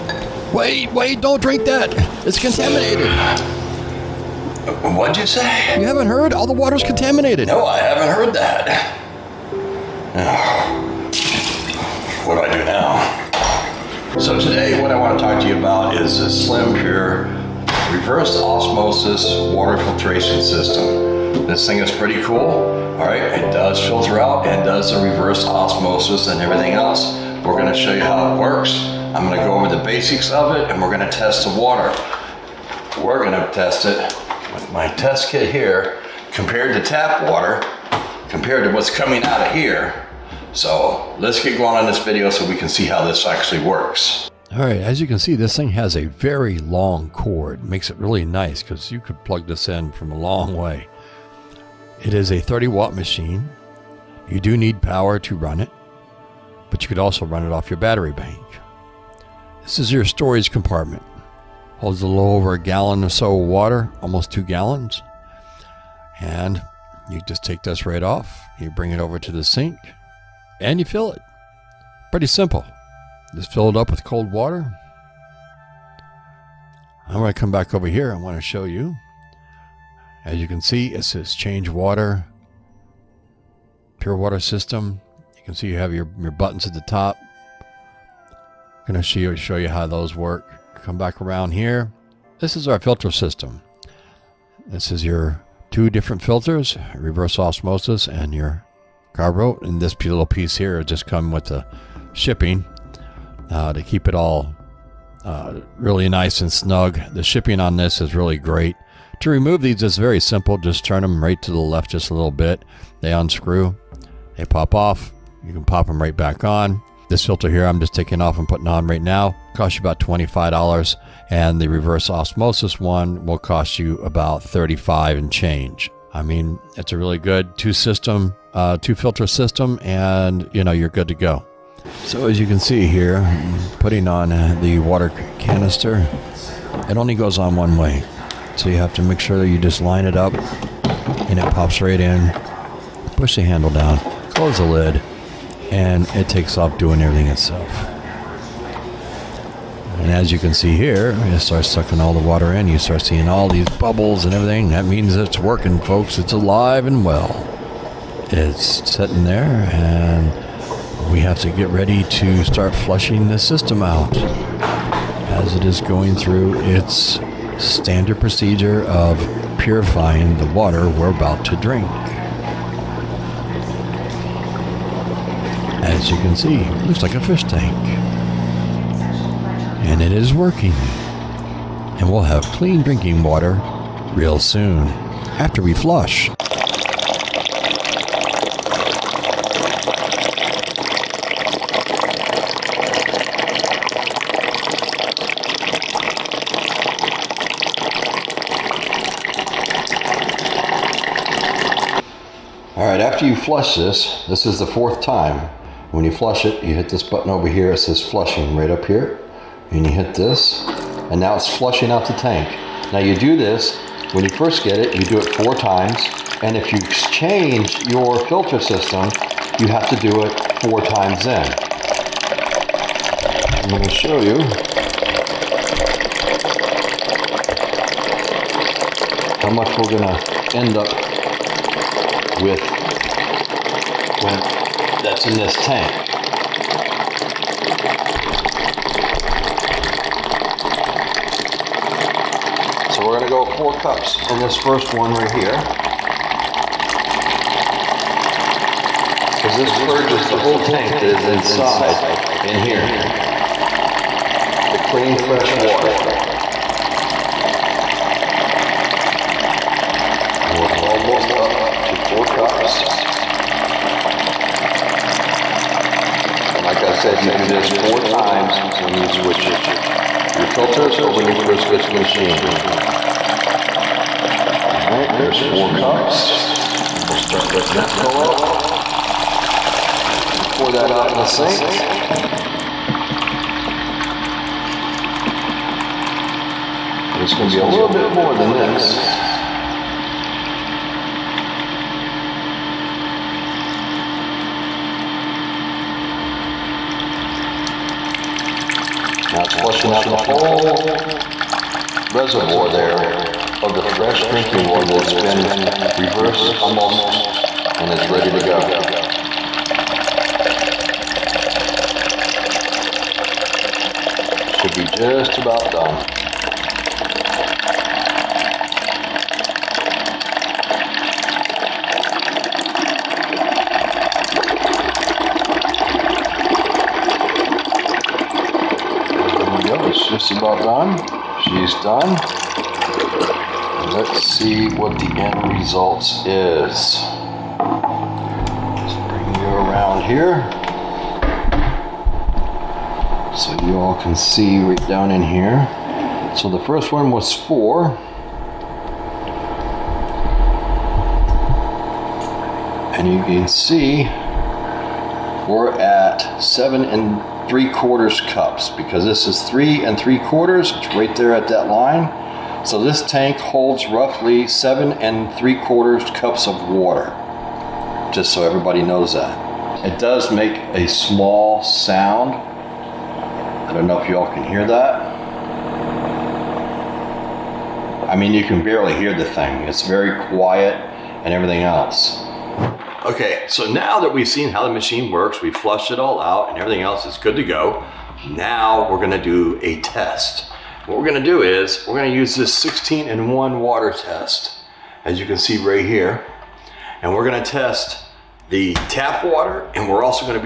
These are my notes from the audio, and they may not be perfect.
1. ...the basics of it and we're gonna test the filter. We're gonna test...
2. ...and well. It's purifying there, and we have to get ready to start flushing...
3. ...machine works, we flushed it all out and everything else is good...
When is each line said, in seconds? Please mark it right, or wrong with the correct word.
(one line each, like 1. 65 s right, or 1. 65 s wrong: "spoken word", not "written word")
1. 29 s wrong: "water", not "filter"
2. 156 s wrong: "sitting", not "purifying"
3. 384 s right.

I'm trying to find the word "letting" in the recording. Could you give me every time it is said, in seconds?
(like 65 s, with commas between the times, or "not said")
277 s.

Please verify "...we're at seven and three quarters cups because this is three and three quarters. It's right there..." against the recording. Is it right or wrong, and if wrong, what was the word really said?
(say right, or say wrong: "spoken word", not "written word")
right.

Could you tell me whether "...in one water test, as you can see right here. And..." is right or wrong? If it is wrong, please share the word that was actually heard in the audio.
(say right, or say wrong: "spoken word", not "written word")
right.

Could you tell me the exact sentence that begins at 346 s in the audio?
So the first one was four.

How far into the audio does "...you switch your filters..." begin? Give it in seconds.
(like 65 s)
268 s.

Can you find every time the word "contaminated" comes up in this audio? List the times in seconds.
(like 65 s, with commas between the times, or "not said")
2 s, 6 s.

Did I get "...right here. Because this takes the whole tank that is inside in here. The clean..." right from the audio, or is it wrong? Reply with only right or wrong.
wrong.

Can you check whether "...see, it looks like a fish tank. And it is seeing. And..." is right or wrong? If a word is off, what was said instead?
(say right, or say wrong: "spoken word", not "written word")
wrong: "working", not "seeing".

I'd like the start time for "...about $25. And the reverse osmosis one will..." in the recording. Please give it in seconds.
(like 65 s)
119 s.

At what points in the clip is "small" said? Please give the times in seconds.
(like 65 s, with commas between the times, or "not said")
370 s.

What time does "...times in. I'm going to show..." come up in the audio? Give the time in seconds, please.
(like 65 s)
220 s.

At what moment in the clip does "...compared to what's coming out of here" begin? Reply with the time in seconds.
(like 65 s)
38 s.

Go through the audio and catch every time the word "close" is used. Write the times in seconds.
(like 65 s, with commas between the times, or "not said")
144 s.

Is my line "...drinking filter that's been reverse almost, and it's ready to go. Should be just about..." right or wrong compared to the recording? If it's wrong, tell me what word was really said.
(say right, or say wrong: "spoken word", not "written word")
wrong: "water", not "filter".